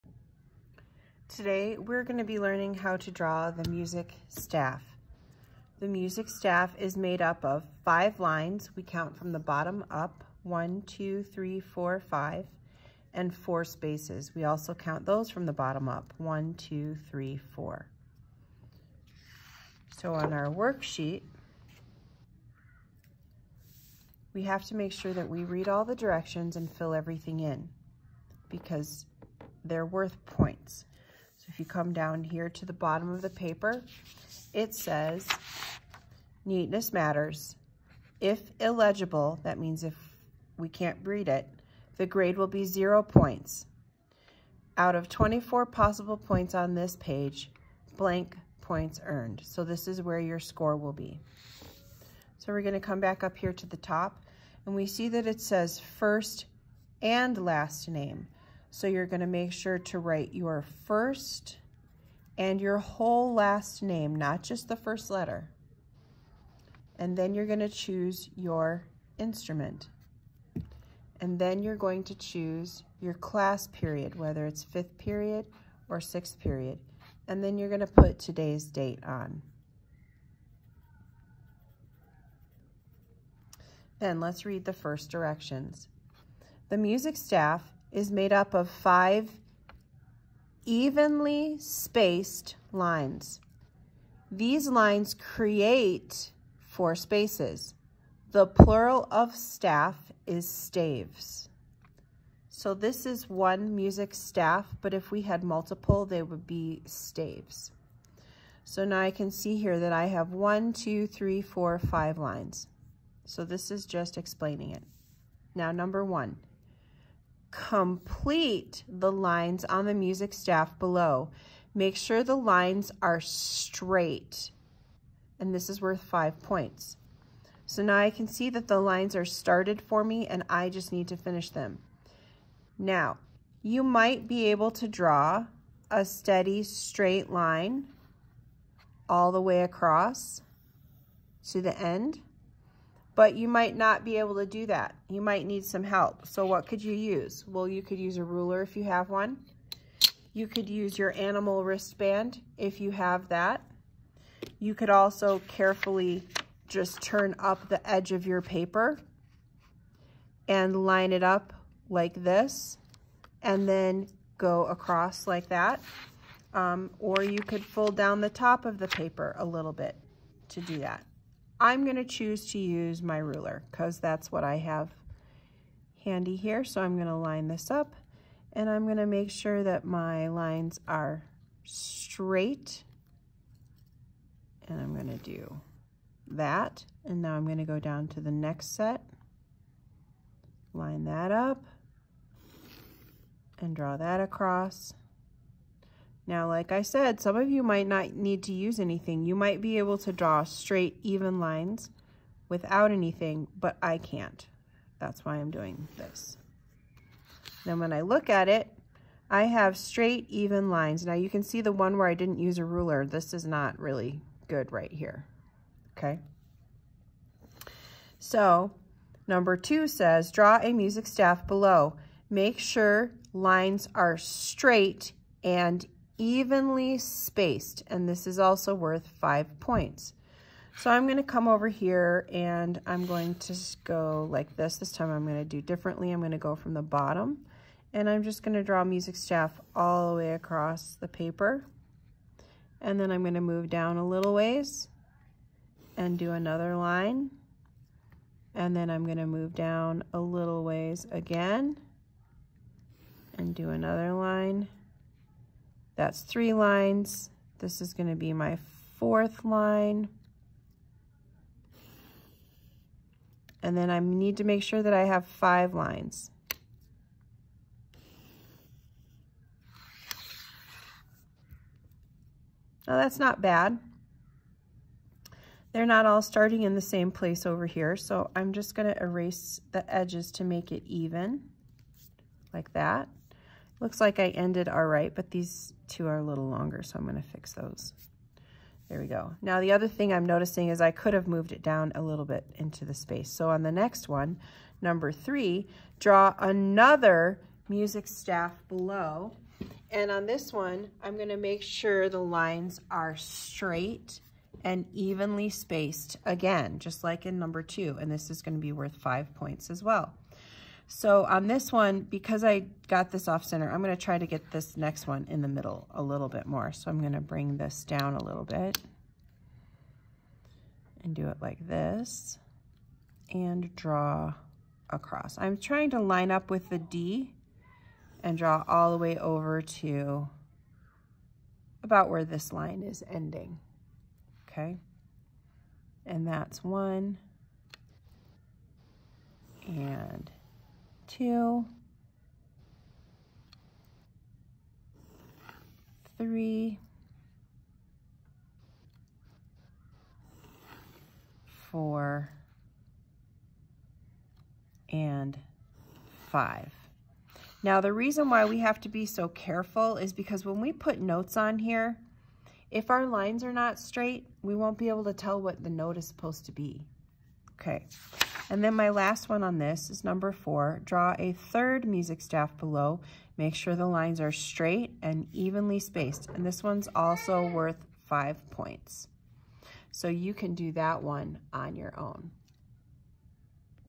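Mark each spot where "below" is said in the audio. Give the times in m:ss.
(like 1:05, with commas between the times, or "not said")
2:00, 3:41, 4:58, 6:12.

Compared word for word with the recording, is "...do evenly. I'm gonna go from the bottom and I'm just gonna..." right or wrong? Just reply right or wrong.
wrong.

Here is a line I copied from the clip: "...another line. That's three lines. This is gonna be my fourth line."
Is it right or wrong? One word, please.
right.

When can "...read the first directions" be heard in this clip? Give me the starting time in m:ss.
1:24.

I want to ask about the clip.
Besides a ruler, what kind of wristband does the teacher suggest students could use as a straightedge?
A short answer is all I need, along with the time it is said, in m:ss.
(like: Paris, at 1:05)
Animal wristband, at 2:31.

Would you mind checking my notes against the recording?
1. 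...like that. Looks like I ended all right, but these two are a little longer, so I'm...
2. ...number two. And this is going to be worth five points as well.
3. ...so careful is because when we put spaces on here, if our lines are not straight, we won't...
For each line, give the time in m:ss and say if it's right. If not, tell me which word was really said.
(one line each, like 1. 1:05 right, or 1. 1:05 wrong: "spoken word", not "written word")
1. 4:42 right
2. 5:07 right
3. 5:59 wrong: "notes", not "spaces".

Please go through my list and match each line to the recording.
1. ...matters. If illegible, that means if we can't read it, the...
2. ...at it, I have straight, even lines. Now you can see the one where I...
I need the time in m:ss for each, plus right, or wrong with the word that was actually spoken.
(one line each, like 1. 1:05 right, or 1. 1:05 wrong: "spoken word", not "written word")
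1. 0:36 right
2. 3:28 right.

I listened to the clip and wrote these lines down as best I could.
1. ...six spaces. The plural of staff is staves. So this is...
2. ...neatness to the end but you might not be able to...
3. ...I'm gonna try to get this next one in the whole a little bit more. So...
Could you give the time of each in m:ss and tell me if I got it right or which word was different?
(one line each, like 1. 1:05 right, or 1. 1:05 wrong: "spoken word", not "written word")
1. 1:36 wrong: "four", not "six"
2. 2:19 wrong: "across", not "neatness"
3. 5:13 wrong: "middle", not "whole".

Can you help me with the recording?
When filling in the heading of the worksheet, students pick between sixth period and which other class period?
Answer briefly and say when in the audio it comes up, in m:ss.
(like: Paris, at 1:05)
Fifth period, at 1:14.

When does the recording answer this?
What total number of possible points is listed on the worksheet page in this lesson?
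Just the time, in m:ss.
0:45.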